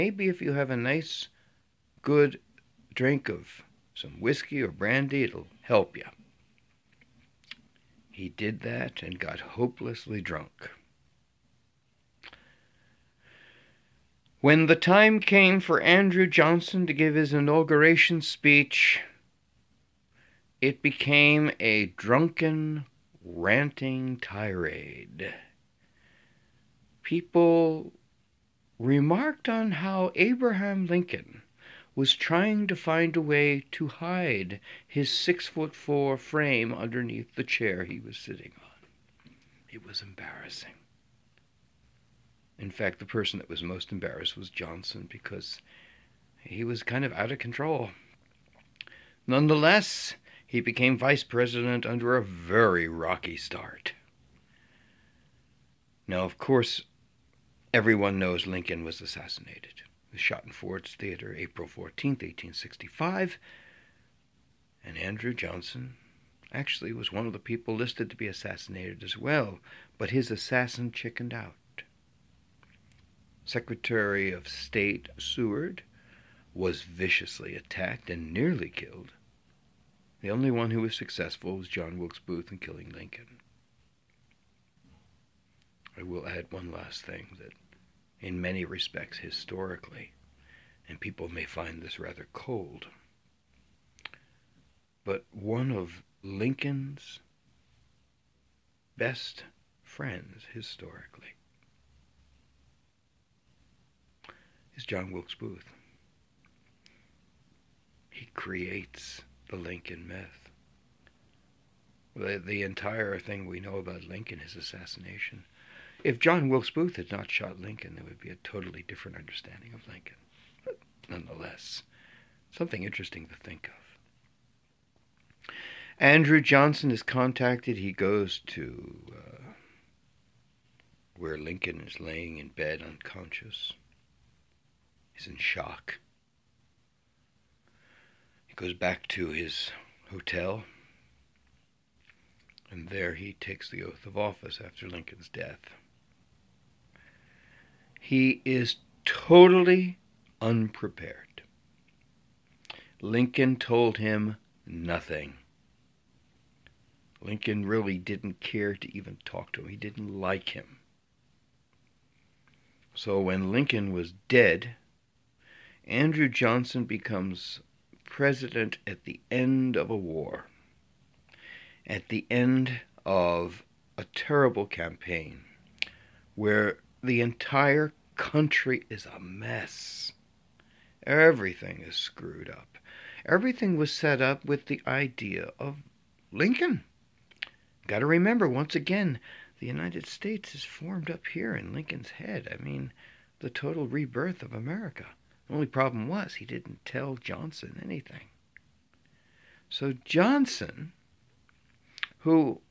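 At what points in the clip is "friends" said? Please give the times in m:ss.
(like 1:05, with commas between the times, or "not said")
1:39.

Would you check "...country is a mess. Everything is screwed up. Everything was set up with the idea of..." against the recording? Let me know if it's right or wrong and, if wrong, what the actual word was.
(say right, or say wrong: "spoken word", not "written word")
right.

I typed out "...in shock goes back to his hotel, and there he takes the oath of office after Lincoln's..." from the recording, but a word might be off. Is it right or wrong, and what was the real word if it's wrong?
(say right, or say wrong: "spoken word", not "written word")
right.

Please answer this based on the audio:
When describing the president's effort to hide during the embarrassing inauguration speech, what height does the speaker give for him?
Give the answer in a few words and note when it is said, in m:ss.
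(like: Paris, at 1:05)
six foot four, at 0:35.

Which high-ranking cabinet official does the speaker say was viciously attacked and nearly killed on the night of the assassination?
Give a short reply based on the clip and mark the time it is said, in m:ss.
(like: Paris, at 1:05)
Secretary of State Seward, at 1:13.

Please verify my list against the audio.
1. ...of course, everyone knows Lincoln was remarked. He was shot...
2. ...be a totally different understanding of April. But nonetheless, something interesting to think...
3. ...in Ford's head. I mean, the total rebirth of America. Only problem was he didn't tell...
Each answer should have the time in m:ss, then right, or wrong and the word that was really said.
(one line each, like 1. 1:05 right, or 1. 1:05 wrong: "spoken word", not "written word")
1. 0:56 wrong: "assassinated", not "remarked"
2. 1:58 wrong: "Lincoln", not "April"
3. 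3:11 wrong: "Lincoln", not "Ford".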